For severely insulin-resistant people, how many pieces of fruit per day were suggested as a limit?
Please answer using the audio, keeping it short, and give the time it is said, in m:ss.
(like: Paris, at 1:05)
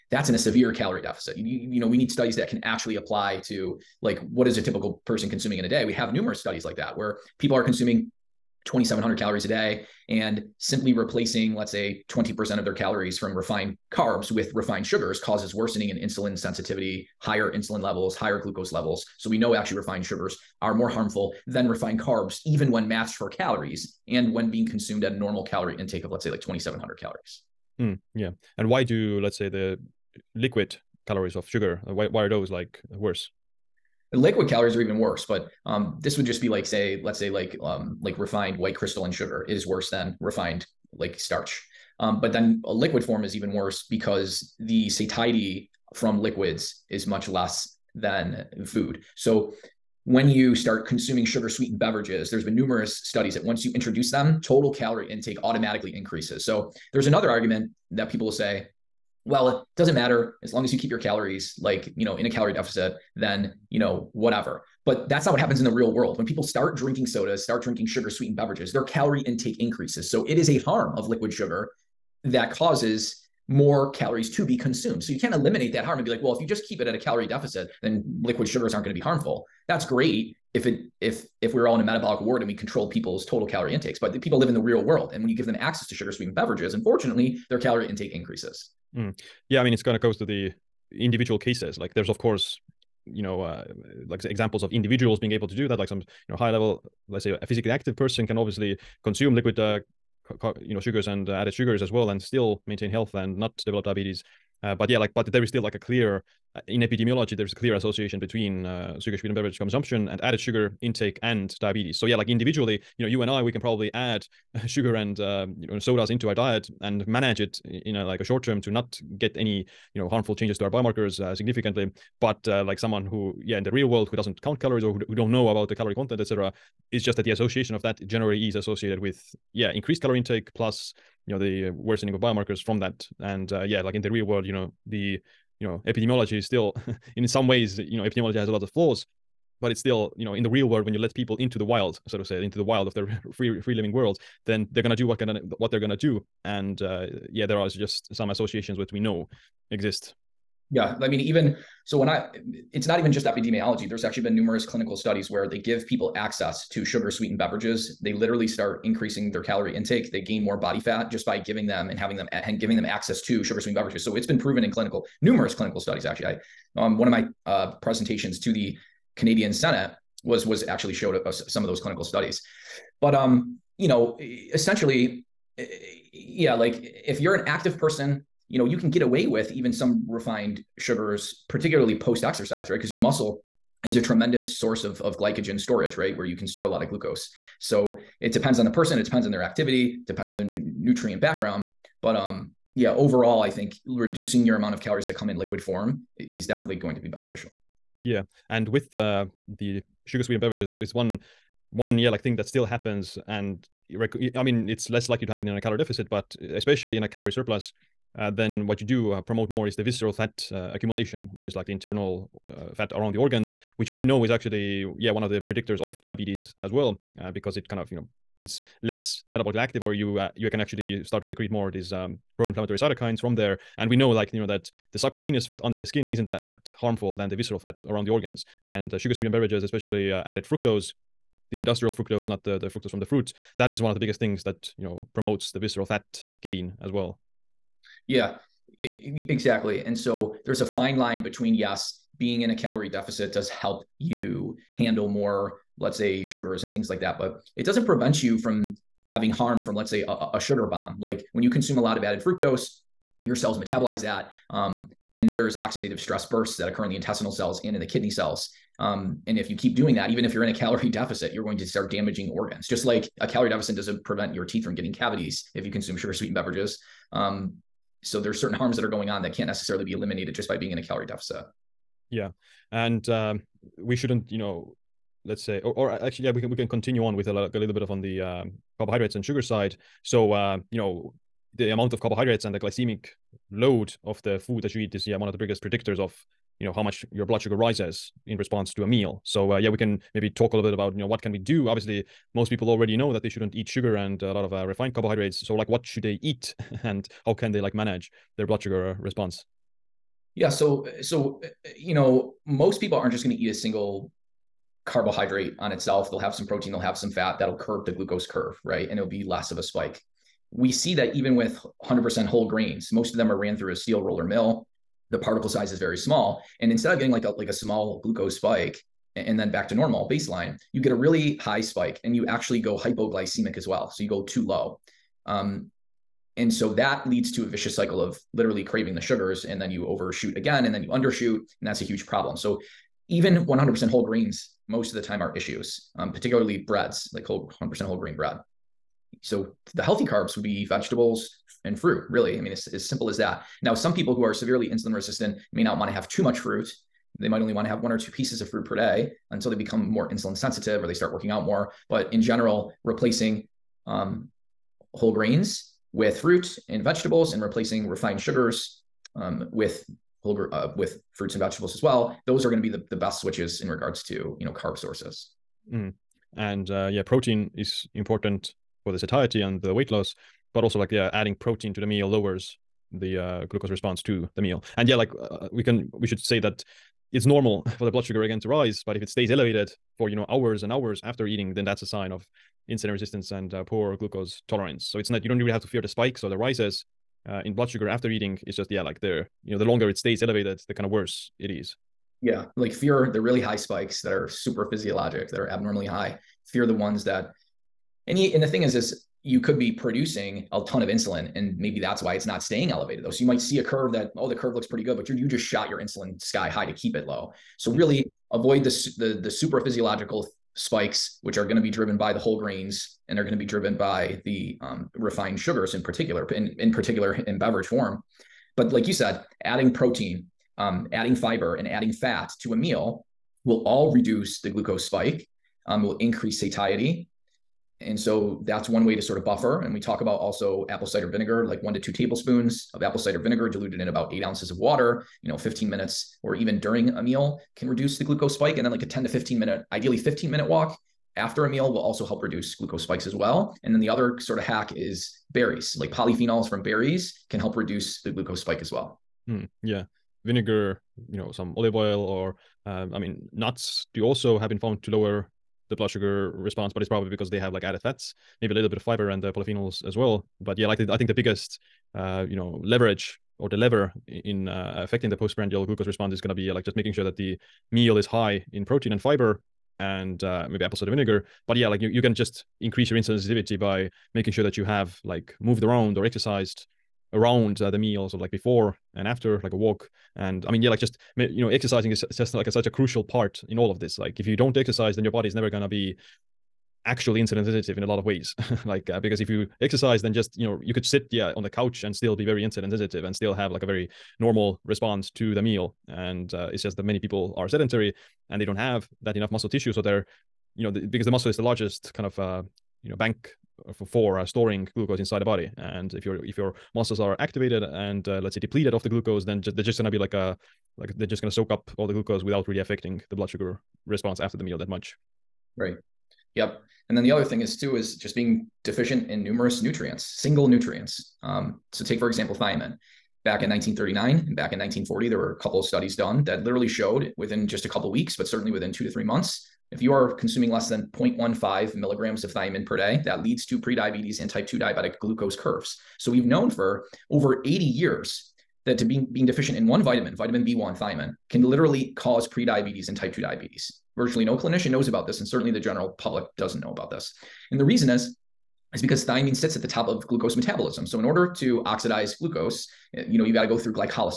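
1 or 2, at 5:47.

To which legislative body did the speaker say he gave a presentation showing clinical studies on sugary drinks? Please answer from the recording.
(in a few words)
Canadian Senate.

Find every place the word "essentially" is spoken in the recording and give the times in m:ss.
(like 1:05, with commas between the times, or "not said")
2:54.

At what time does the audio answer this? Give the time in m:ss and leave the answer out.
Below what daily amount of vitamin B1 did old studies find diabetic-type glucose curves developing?
8:50.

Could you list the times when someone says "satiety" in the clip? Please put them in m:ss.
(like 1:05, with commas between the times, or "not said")
0:44, 6:08, 7:06.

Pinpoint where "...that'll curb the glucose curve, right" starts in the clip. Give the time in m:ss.
5:07.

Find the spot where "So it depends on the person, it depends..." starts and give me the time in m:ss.
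3:07.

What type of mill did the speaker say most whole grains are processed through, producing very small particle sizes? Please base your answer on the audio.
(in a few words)
steel roller mill.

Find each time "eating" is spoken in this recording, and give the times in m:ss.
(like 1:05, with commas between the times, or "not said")
6:21, 6:28.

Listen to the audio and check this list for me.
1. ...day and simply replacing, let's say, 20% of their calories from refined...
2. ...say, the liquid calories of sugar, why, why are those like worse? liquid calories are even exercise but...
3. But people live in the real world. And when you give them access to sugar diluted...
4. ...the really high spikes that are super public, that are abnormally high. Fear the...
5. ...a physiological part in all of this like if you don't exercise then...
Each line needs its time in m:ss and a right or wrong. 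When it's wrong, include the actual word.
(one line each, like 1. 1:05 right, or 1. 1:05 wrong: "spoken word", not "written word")
1. 0:09 right
2. 0:29 wrong: "worse", not "exercise"
3. 1:23 wrong: "sweetened", not "diluted"
4. 6:33 wrong: "physiologic", not "public"
5. 8:02 wrong: "crucial", not "physiological".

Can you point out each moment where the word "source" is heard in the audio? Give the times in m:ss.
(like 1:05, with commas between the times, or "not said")
3:04, 6:04.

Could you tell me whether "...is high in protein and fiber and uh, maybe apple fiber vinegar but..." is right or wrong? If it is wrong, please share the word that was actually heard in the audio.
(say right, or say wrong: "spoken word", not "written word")
wrong: "cider", not "fiber".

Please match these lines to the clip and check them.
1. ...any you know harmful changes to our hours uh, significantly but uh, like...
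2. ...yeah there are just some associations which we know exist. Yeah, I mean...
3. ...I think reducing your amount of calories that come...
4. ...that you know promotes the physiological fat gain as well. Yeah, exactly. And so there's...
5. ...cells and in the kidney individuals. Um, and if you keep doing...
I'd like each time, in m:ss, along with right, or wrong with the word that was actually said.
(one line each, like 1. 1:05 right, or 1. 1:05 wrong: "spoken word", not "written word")
1. 1:59 wrong: "biomarkers", not "hours"
2. 2:27 right
3. 3:13 right
4. 3:54 wrong: "visceral", not "physiological"
5. 4:17 wrong: "cells", not "individuals".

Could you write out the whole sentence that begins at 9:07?
And the reason is, is because thiamine sits at the top of glucose metabolism.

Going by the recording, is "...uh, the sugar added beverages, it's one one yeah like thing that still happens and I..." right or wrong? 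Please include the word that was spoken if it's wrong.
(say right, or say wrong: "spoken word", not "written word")
wrong: "sweetened", not "added".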